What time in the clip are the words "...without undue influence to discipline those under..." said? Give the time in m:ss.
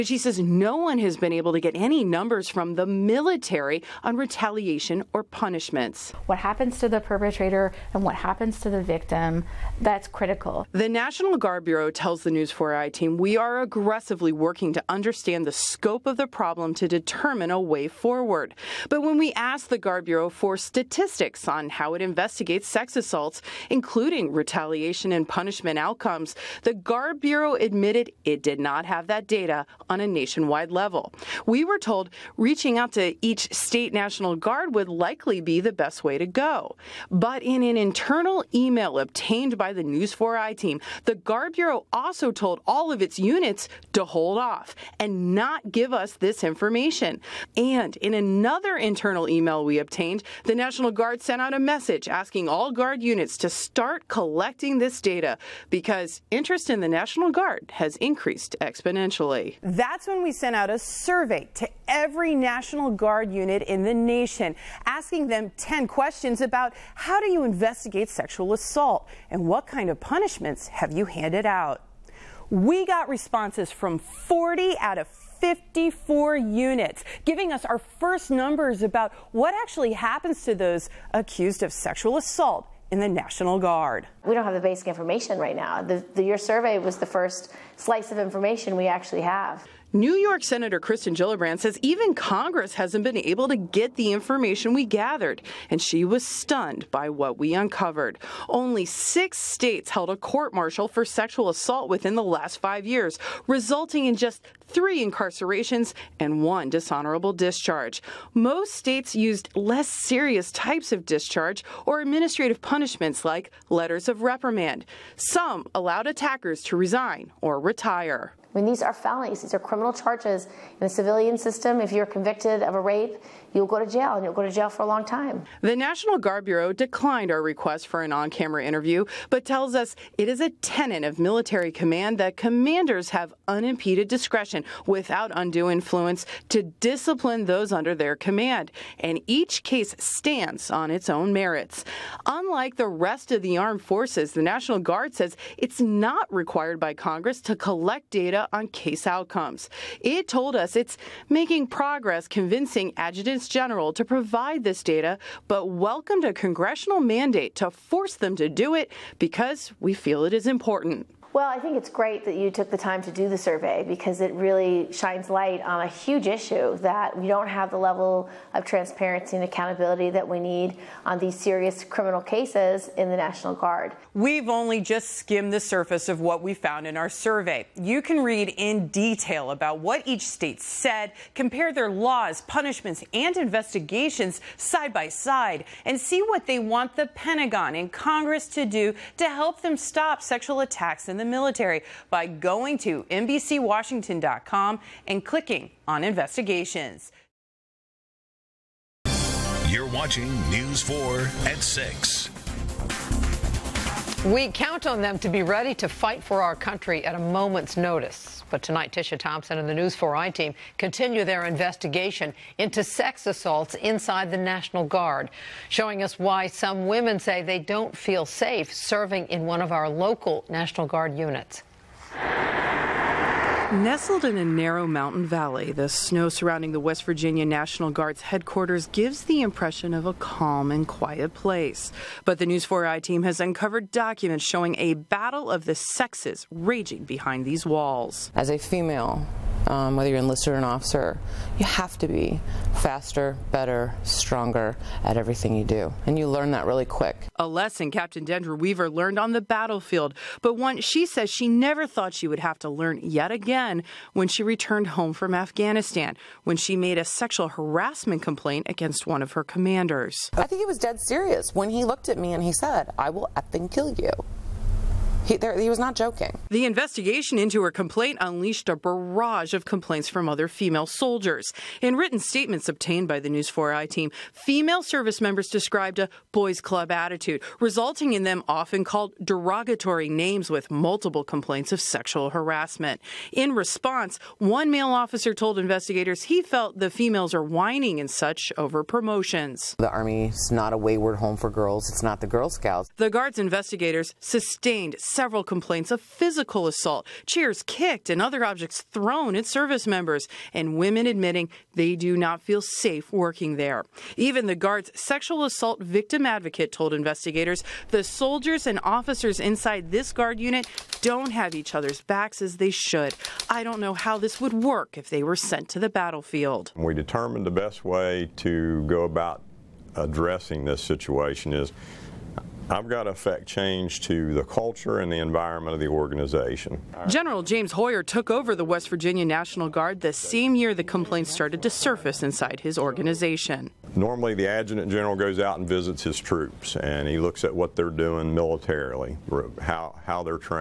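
2:14.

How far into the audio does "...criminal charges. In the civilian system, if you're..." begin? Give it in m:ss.
1:59.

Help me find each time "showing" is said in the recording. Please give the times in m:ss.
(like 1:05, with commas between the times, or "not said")
3:35, 3:54.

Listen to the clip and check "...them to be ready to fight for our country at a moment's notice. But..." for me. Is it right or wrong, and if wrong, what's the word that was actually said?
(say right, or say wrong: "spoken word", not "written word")
right.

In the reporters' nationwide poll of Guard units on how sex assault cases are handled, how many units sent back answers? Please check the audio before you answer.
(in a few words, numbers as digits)
40.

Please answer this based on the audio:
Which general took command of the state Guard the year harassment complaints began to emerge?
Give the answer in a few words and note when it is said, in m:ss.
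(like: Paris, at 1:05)
James Hoyer, at 5:27.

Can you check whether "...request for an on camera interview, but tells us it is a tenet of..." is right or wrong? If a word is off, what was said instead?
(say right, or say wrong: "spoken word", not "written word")
right.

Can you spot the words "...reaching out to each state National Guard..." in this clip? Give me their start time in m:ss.
0:32.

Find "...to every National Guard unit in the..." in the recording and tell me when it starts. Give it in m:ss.
1:01.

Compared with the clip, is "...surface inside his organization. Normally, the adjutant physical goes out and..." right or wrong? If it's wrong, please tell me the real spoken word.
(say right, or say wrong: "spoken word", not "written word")
wrong: "general", not "physical".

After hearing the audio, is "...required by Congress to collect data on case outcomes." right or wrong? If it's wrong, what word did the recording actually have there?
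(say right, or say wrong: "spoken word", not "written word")
right.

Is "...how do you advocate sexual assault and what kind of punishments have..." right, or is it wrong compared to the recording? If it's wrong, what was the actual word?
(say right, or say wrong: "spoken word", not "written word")
wrong: "investigate", not "advocate".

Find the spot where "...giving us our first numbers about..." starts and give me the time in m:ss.
1:17.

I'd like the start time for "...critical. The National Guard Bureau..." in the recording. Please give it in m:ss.
0:10.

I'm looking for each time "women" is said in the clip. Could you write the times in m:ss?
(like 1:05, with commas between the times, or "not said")
3:36, 5:00.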